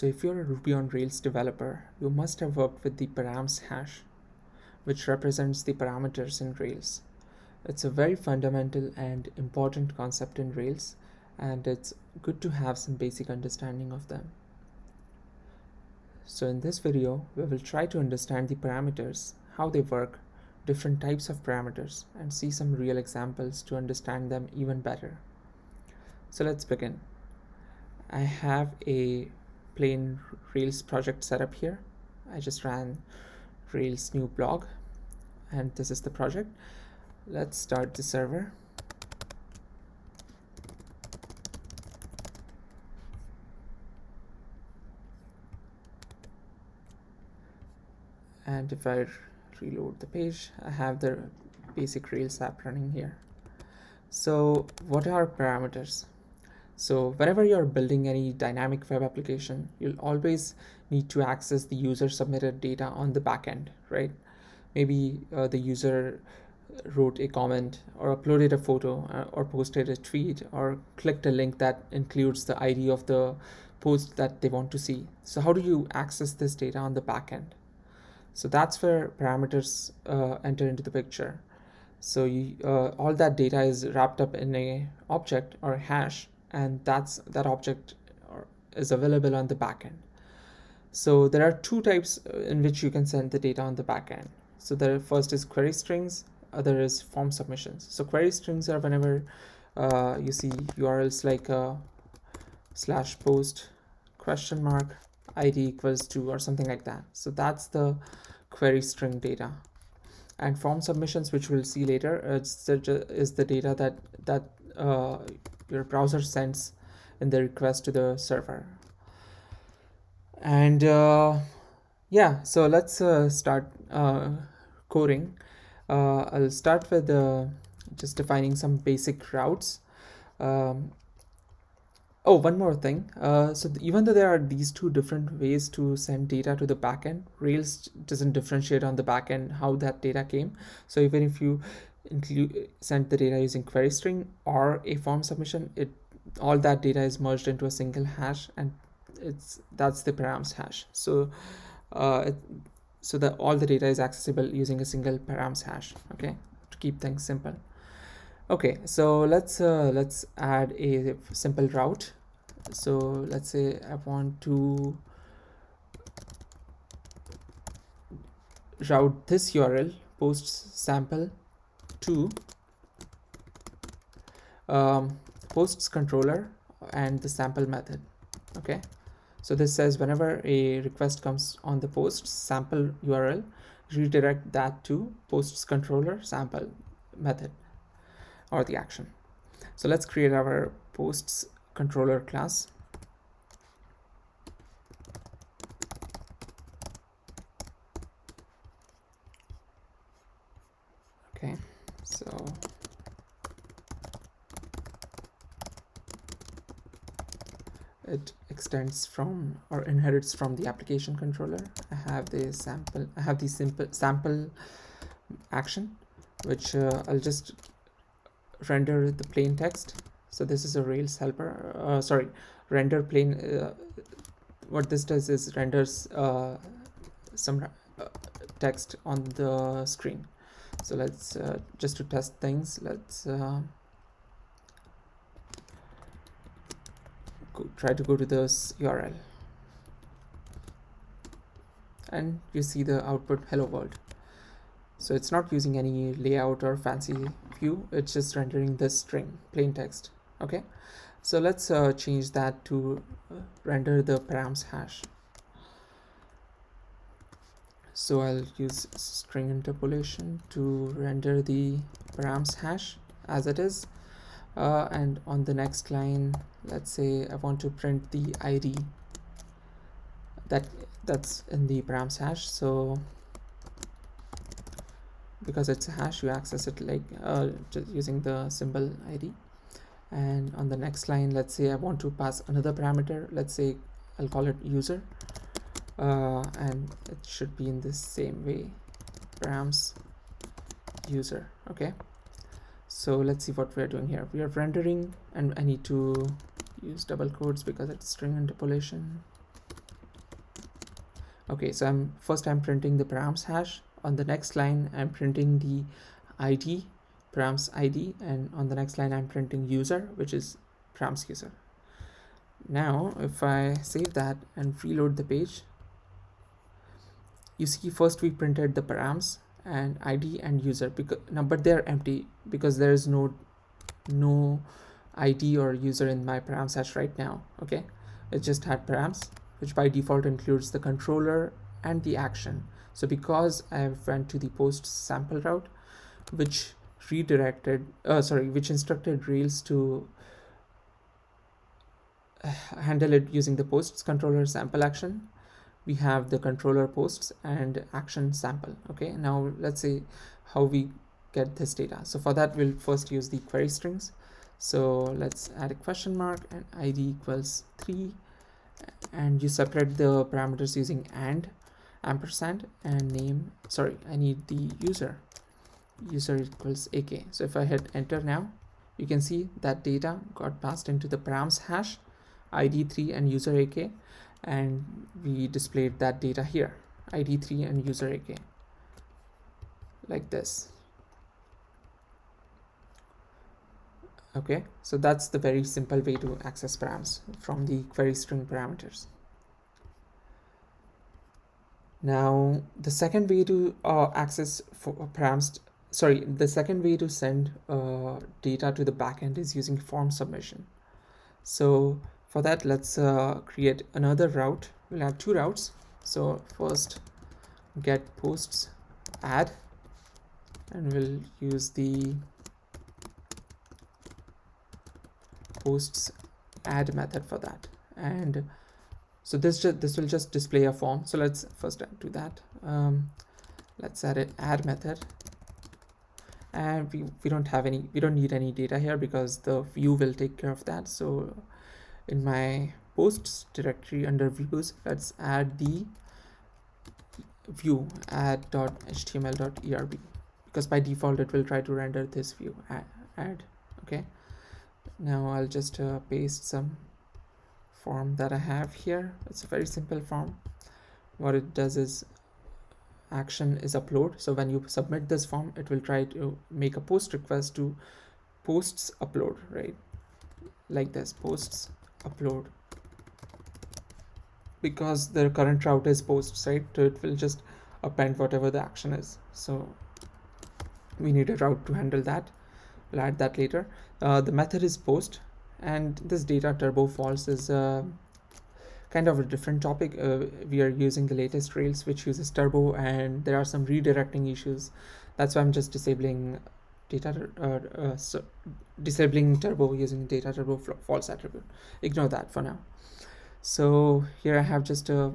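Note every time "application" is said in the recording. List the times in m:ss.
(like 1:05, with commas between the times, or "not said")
0:59, 3:30.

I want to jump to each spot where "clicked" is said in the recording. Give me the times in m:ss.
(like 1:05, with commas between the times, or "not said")
1:10.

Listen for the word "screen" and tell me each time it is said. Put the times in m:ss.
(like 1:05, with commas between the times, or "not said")
3:49.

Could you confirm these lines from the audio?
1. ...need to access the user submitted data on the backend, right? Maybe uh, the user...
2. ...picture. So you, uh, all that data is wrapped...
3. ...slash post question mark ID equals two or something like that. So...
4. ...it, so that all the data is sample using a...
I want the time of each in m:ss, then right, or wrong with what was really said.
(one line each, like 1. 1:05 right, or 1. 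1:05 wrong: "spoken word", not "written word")
1. 1:00 right
2. 1:20 right
3. 1:42 right
4. 2:32 wrong: "accessible", not "sample".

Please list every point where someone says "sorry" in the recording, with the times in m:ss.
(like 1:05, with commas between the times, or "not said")
3:42, 5:38, 6:03, 6:35.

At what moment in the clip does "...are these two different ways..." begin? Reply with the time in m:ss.
2:14.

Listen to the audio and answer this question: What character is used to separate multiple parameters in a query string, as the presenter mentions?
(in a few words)
ampersand.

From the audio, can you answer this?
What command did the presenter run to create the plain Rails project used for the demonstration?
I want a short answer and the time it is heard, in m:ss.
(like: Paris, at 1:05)
rails new blog, at 0:33.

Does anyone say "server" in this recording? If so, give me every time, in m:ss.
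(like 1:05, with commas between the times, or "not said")
0:38, 1:58.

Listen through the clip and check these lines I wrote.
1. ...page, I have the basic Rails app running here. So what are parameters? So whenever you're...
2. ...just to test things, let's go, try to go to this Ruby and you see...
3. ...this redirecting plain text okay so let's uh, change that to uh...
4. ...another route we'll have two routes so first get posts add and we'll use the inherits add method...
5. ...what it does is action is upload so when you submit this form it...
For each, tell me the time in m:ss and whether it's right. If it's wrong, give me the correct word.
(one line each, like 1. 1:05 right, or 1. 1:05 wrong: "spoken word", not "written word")
1. 0:50 right
2. 3:51 wrong: "URL", not "Ruby"
3. 4:08 wrong: "string", not "redirecting"
4. 6:43 wrong: "posts", not "inherits"
5. 7:31 right.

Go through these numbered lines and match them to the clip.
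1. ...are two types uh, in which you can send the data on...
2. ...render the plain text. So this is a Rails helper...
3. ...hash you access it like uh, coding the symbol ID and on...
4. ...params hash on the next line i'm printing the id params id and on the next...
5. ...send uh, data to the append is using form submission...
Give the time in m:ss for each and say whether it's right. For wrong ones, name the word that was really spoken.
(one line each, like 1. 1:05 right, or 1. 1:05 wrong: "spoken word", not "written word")
1. 1:31 right
2. 3:38 right
3. 4:35 wrong: "using", not "coding"
4. 5:03 right
5. 6:37 wrong: "backend", not "append".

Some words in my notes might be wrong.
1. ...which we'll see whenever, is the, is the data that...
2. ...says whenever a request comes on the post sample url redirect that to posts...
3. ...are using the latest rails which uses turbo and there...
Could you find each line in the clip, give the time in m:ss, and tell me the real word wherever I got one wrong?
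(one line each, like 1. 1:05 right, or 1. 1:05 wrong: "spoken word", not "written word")
1. 1:51 wrong: "later", not "whenever"
2. 2:59 right
3. 8:00 right.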